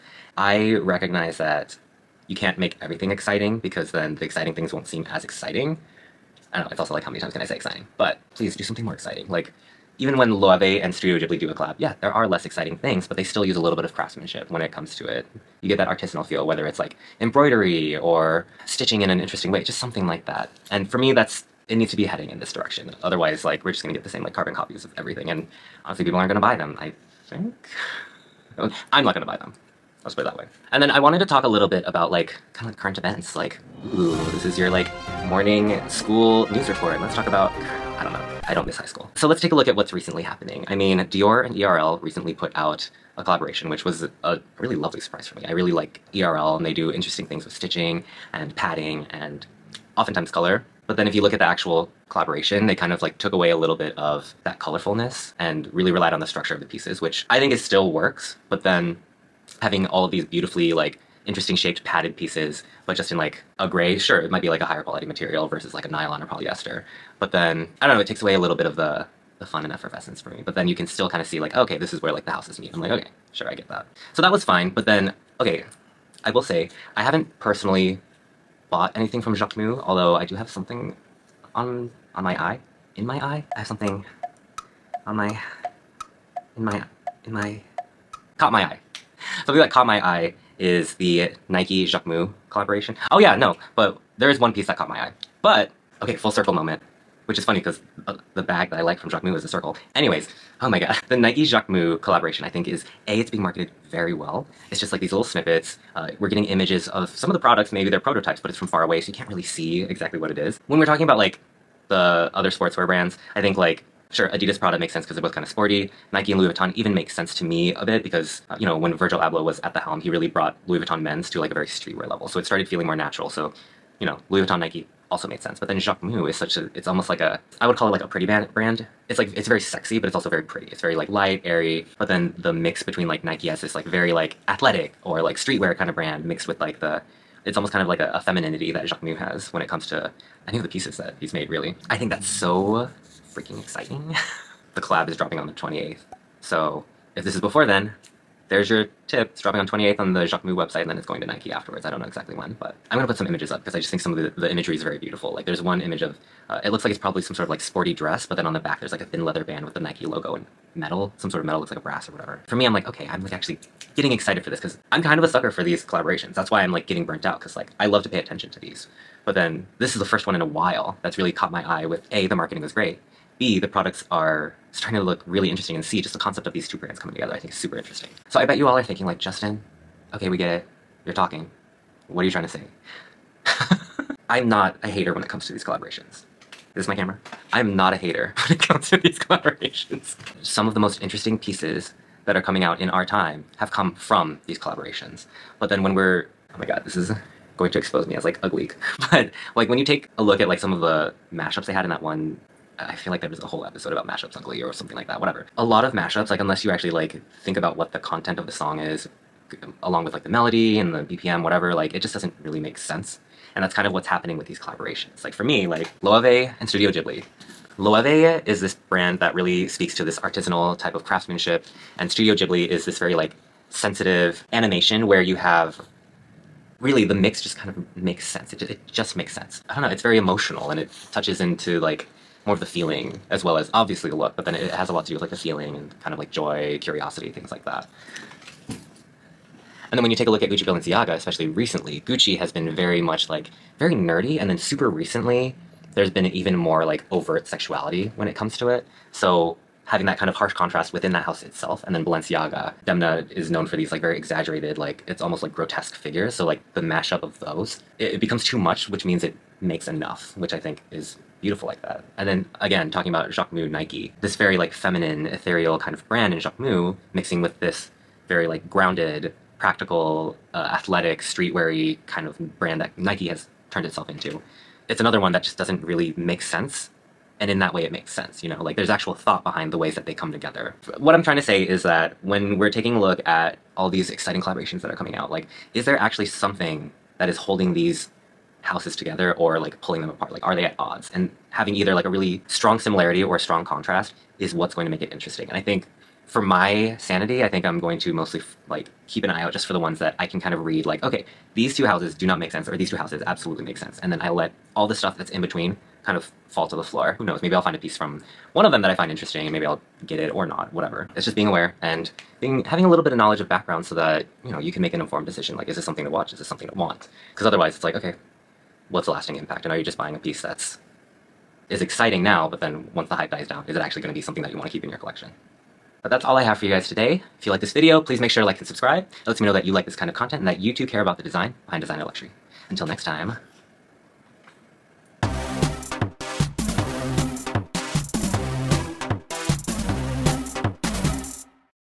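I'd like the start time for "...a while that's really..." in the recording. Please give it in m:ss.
2:50.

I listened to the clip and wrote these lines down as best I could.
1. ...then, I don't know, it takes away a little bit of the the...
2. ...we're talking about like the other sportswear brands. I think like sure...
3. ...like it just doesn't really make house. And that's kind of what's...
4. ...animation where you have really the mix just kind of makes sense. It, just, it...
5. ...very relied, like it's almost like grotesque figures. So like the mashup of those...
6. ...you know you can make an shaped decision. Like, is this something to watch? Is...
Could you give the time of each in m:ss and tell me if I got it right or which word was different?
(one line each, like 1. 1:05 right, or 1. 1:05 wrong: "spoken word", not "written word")
1. 1:07 right
2. 1:50 right
3. 3:31 wrong: "sense", not "house"
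4. 3:44 right
5. 4:14 wrong: "exaggerated", not "relied"
6. 5:14 wrong: "informed", not "shaped".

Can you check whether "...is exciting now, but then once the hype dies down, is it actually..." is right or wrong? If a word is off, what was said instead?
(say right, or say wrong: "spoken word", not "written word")
right.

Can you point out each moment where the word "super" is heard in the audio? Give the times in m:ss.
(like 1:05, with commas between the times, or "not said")
2:57, 4:04.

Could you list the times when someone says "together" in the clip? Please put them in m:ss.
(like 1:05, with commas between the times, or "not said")
2:57, 4:40, 4:48.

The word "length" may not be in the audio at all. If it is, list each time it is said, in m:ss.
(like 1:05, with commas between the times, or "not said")
not said.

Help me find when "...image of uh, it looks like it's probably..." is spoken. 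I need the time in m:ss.
2:35.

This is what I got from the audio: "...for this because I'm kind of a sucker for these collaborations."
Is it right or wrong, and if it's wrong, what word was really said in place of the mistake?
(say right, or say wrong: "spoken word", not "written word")
right.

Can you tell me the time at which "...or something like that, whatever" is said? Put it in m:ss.
3:24.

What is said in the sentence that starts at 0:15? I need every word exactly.
You get that artisanal feel, whether it's like embroidery or stitching in an interesting way, just something like that.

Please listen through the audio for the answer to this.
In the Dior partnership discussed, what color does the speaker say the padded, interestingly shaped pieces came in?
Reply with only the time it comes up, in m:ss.
1:03.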